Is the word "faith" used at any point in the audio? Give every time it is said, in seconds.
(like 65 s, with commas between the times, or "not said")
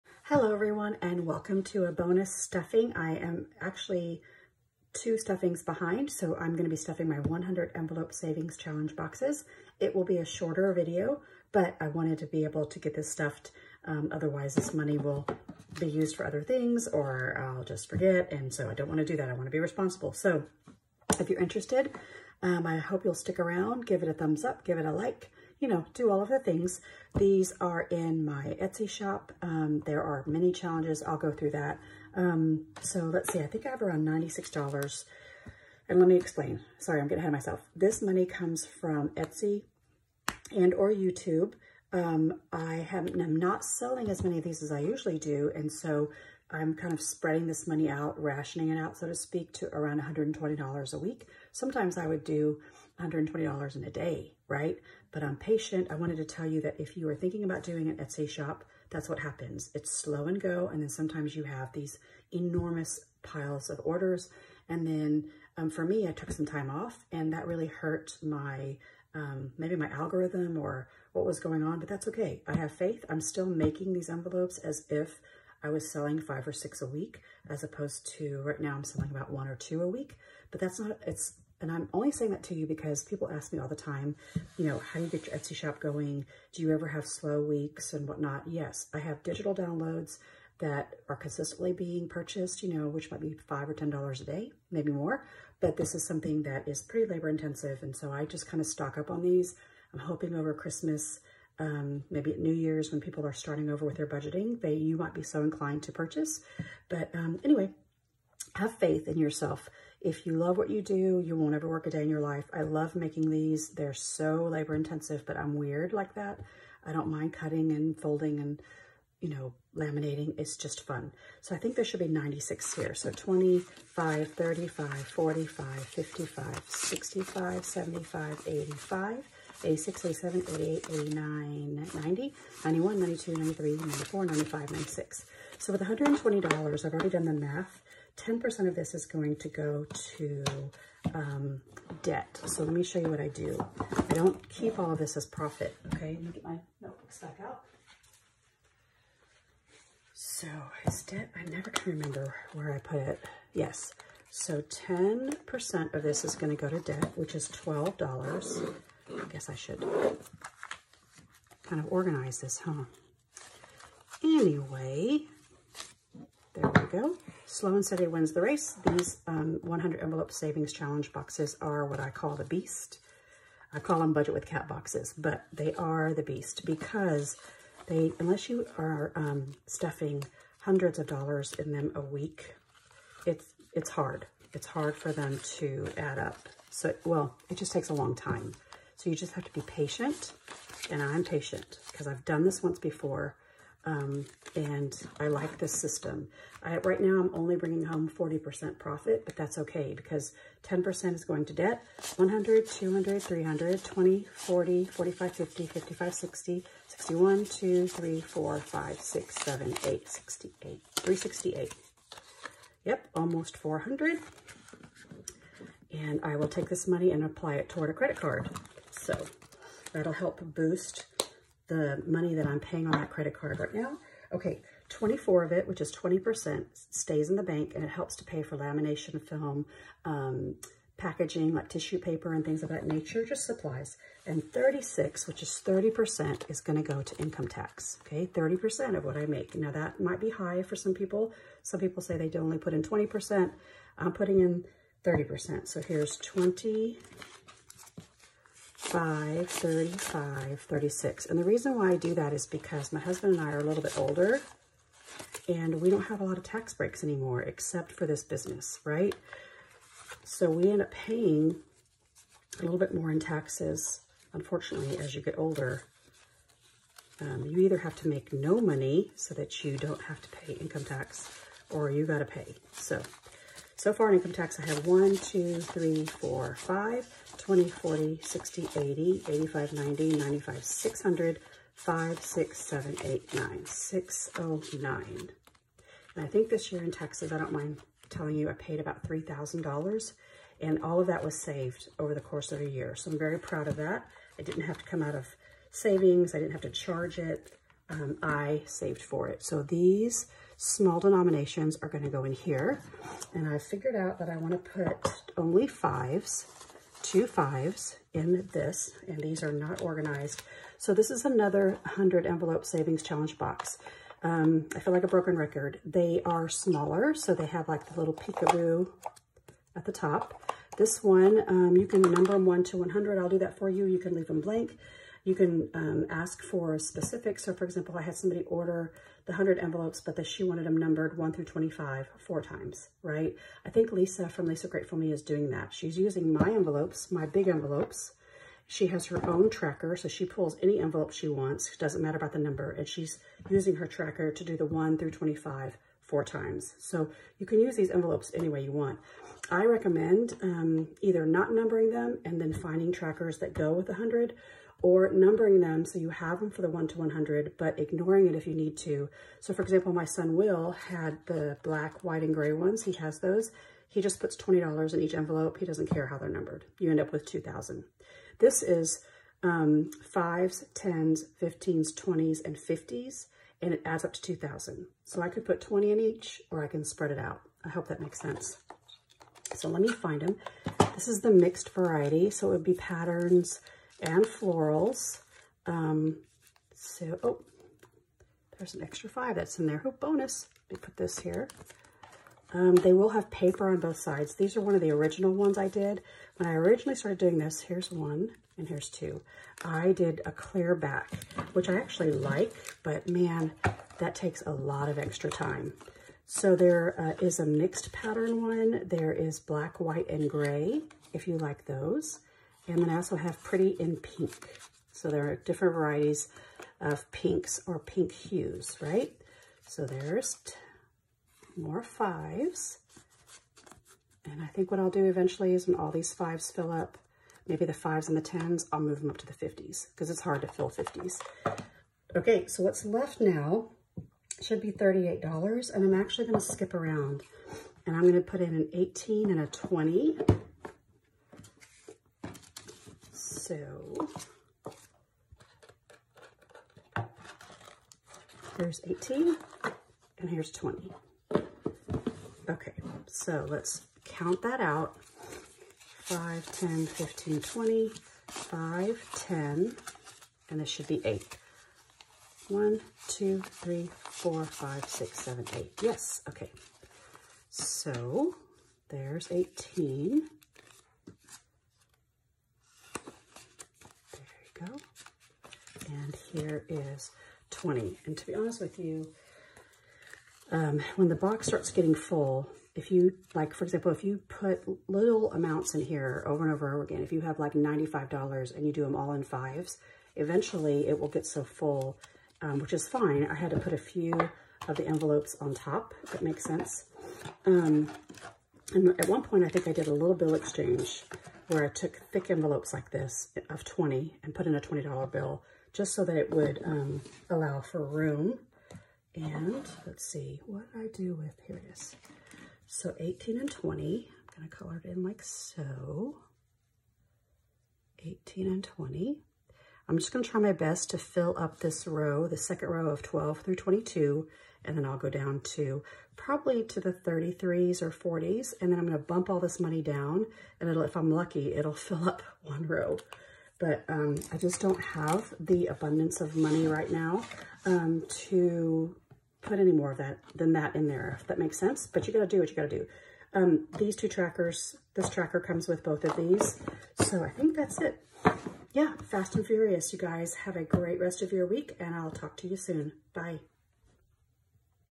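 72 s, 108 s.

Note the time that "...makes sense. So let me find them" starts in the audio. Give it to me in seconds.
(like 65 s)
378 s.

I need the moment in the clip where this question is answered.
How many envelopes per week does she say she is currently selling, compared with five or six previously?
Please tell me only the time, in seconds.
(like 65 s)
79 s.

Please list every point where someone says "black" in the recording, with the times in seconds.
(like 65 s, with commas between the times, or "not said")
361 s, 409 s.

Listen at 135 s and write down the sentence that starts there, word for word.
So with $120, I've already done the math.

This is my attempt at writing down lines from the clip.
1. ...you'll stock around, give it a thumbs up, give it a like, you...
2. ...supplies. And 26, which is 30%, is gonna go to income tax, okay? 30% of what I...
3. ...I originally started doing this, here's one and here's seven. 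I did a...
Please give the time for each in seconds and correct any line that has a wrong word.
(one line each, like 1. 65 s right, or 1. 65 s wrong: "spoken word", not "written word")
1. 23 s wrong: "stick", not "stock"
2. 233 s wrong: "36", not "26"
3. 396 s wrong: "two", not "seven".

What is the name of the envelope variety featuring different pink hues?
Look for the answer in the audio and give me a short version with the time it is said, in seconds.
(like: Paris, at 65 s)
Pretty in Pink, at 413 s.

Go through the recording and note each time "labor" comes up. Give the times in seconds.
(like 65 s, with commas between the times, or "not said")
97 s, 114 s.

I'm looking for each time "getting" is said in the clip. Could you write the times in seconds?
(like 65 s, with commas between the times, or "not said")
37 s, 481 s.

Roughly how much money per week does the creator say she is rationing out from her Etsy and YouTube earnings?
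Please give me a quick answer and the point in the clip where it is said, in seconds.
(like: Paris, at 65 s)
$120, at 49 s.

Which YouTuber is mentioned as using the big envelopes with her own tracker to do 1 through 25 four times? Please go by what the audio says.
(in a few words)
Lisa Grateful Me.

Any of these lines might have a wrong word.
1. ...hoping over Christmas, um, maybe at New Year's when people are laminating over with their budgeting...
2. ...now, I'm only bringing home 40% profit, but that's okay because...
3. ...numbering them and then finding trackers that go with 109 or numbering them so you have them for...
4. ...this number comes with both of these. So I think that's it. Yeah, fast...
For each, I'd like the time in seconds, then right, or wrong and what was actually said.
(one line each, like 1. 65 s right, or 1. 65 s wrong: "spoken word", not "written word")
1. 99 s wrong: "starting", not "laminating"
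2. 197 s right
3. 351 s wrong: "100", not "109"
4. 544 s wrong: "tracker", not "number".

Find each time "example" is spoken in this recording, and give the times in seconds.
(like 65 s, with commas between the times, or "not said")
327 s, 359 s, 483 s.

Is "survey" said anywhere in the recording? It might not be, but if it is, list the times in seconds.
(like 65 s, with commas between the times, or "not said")
not said.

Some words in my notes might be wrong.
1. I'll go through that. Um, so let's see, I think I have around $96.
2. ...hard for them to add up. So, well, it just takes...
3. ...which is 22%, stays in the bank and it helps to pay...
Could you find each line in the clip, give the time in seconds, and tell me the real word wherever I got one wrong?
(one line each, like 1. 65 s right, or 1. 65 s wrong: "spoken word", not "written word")
1. 31 s right
2. 184 s right
3. 225 s wrong: "20", not "22".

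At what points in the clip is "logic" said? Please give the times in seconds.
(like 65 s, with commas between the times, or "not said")
not said.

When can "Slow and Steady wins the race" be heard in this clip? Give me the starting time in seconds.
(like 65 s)
167 s.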